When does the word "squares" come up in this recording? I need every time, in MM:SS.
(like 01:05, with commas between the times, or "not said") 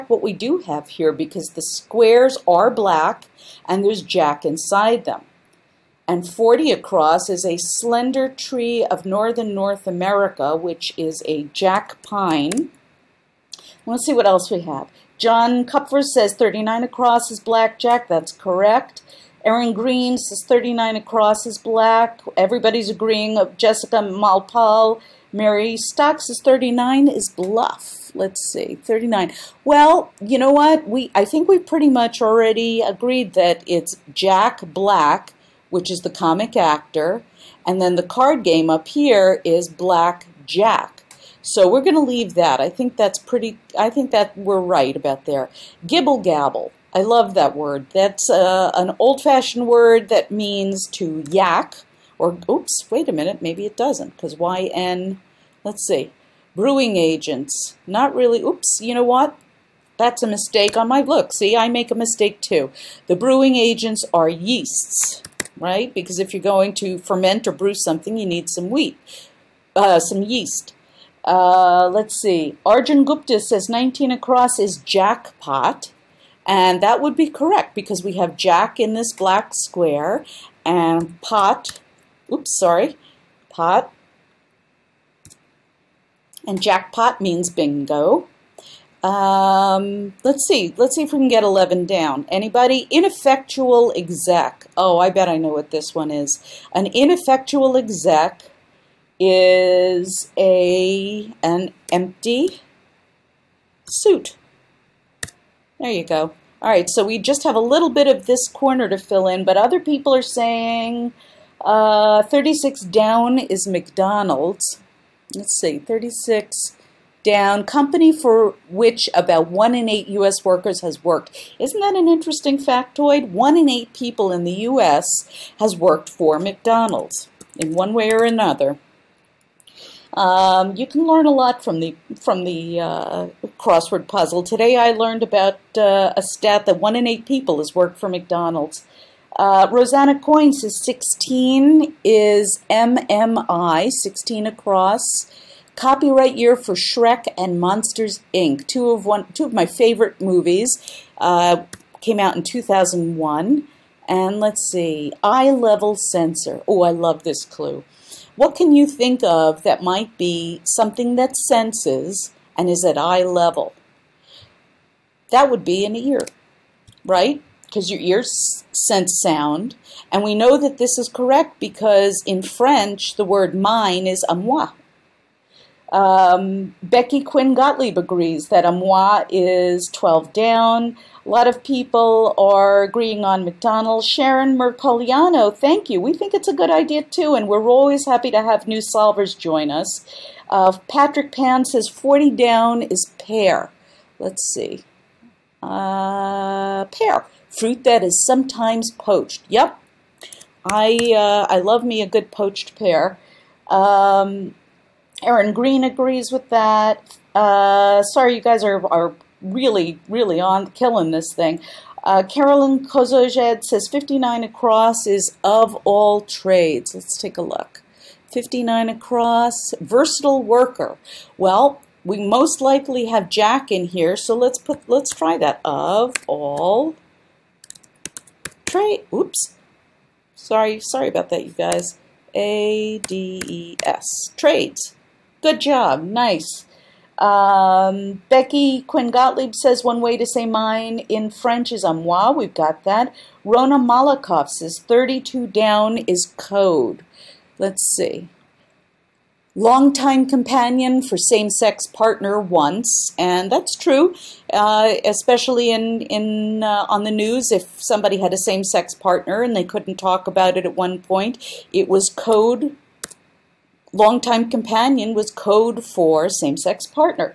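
00:01, 01:19.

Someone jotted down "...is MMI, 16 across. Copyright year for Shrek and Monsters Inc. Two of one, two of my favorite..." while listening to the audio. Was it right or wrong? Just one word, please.
right.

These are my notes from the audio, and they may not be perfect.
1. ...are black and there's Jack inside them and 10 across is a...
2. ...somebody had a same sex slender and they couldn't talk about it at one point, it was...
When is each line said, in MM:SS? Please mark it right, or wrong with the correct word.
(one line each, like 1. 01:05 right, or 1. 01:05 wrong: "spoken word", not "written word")
1. 00:02 wrong: "40", not "10"
2. 04:17 wrong: "partner", not "slender".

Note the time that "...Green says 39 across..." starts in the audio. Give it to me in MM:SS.
00:19.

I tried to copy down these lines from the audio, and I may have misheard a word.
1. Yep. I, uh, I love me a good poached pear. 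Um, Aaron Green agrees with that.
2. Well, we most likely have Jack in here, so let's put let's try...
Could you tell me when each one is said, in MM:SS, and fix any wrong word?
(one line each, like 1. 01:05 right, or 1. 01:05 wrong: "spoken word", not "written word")
1. 03:19 right
2. 03:41 right.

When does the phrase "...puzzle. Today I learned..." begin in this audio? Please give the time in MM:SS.
02:14.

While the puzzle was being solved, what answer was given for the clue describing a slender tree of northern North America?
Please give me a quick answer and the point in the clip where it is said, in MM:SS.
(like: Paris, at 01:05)
jack pine, at 00:11.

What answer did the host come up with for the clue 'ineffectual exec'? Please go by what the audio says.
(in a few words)
empty suit.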